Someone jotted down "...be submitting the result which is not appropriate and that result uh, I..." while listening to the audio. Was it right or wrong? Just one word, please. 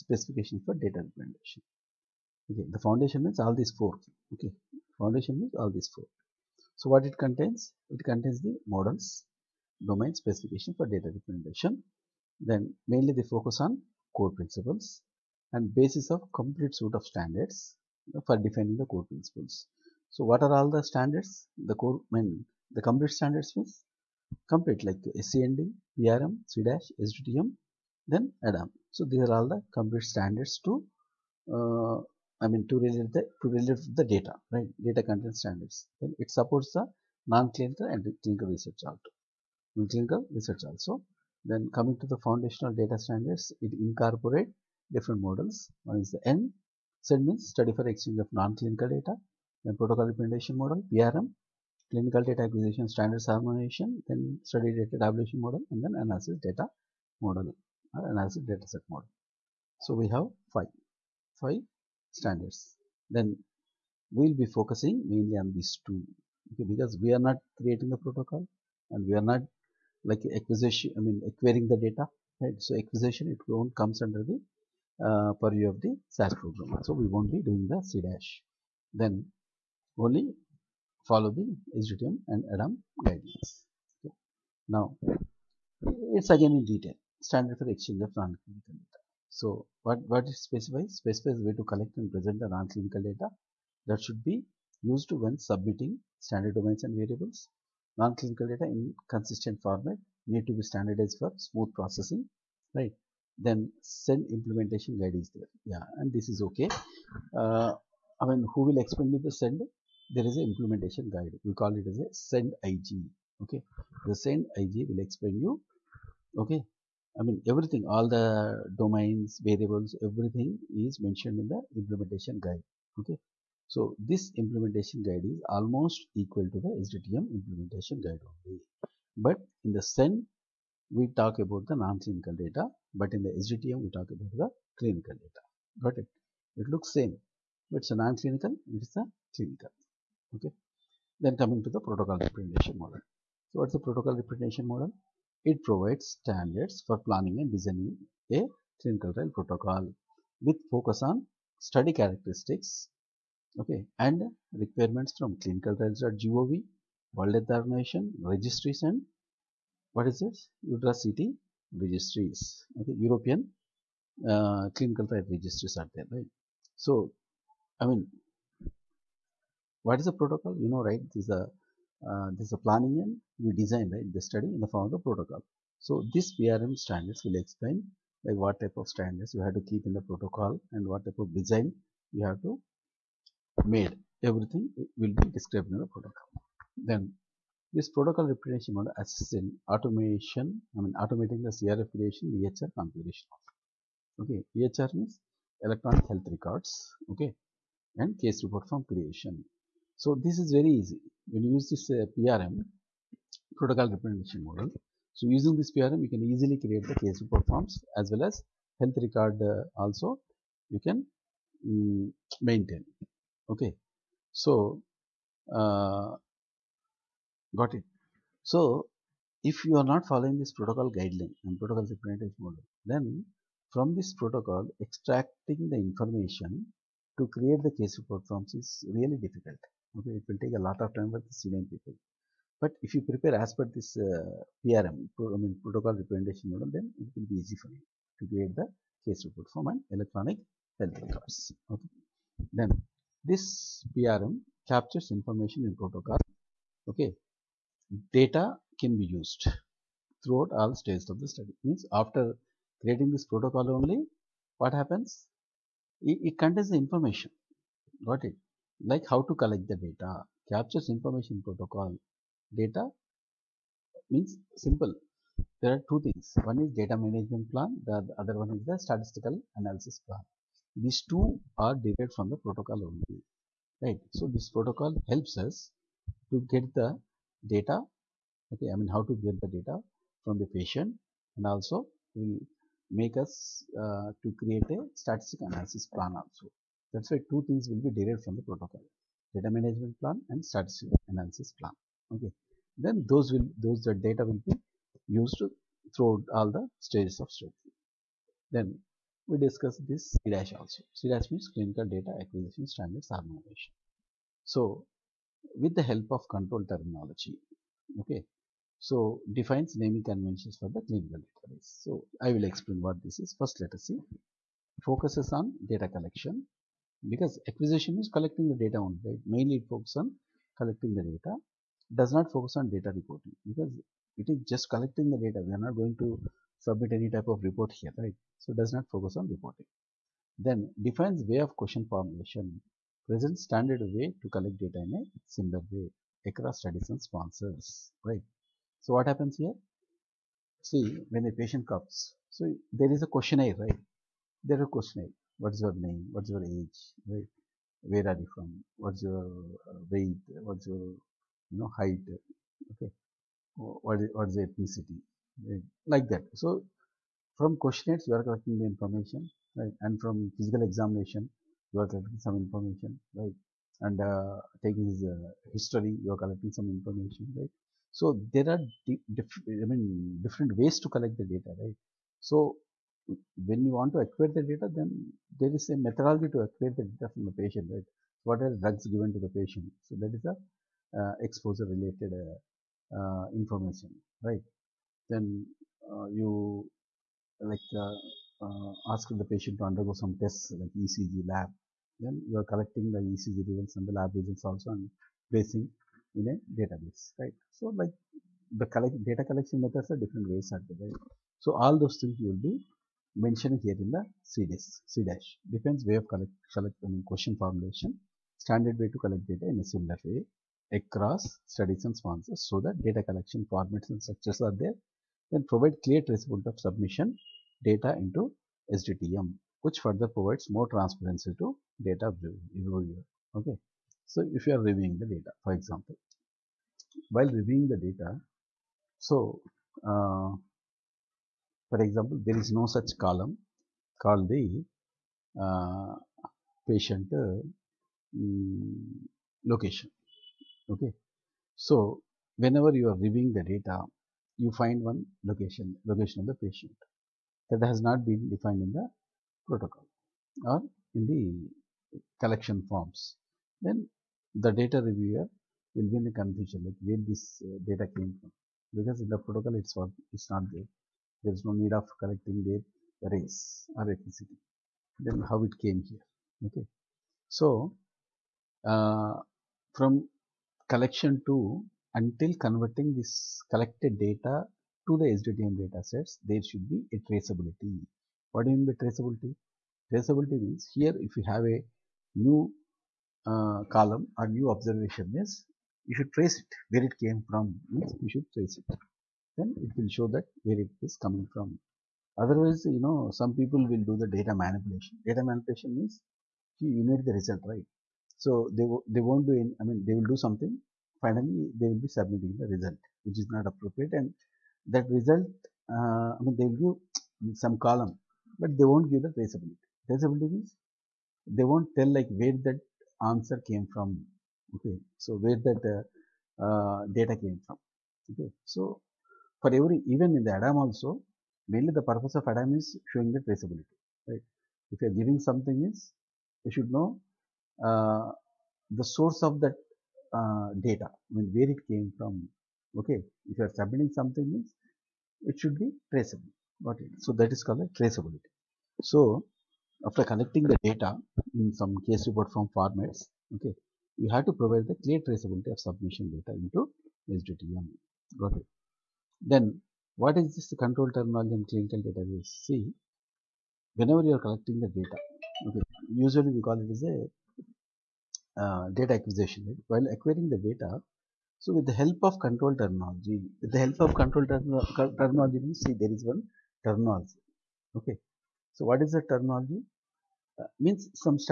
right.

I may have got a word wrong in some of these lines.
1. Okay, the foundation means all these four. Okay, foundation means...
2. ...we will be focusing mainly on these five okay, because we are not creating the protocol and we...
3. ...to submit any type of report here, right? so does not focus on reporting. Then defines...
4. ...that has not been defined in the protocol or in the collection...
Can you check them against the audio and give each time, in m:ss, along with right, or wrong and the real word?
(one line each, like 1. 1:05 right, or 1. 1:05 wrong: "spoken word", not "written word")
1. 0:02 right
2. 1:04 wrong: "two", not "five"
3. 5:25 right
4. 7:27 right.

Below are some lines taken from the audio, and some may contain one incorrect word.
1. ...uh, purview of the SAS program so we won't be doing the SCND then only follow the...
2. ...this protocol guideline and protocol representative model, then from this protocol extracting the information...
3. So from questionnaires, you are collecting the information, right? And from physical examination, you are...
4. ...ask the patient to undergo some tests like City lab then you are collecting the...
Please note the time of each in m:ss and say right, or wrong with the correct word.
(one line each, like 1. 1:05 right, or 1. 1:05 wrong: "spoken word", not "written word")
1. 1:15 wrong: "CDASH", not "SCND"
2. 3:40 right
3. 5:56 right
4. 6:28 wrong: "ECG", not "City".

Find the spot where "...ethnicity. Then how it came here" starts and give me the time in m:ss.
7:43.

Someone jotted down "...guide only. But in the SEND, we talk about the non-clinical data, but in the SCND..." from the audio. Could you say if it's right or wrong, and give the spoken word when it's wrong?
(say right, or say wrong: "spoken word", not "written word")
wrong: "SDTM", not "SCND".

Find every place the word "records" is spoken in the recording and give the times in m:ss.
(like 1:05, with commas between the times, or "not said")
3:16, 3:29, 4:00.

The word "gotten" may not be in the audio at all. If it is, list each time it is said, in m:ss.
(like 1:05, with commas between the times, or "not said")
not said.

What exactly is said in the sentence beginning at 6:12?
So when you want to acquire the data, then there is a methodology to acquire the data from the patient, right?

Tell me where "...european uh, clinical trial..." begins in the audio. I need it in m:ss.
2:43.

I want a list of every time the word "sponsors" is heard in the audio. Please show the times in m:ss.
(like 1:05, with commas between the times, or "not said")
5:37, 6:51.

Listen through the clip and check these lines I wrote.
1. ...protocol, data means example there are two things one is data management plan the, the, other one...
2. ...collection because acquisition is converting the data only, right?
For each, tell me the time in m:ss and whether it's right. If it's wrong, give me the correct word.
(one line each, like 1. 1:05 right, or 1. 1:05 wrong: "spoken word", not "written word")
1. 4:21 wrong: "simple", not "example"
2. 5:15 wrong: "collecting", not "converting".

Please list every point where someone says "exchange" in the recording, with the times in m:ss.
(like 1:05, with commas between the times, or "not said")
0:47, 1:27.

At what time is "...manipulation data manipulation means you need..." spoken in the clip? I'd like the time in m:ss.
8:14.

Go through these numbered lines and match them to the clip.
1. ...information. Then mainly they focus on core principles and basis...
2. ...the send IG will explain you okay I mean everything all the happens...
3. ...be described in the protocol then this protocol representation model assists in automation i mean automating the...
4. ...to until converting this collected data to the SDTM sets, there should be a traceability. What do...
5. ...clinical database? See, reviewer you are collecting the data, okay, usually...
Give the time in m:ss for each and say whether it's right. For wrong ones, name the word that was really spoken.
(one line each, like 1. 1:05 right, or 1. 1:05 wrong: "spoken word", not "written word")
1. 0:11 wrong: "representation", not "information"
2. 1:54 wrong: "domains", not "happens"
3. 3:05 right
4. 7:51 right
5. 9:11 wrong: "whenever", not "reviewer".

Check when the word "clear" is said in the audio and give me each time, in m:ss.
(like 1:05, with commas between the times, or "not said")
6:55, 9:04.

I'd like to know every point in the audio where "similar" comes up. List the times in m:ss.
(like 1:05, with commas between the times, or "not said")
5:35, 6:49.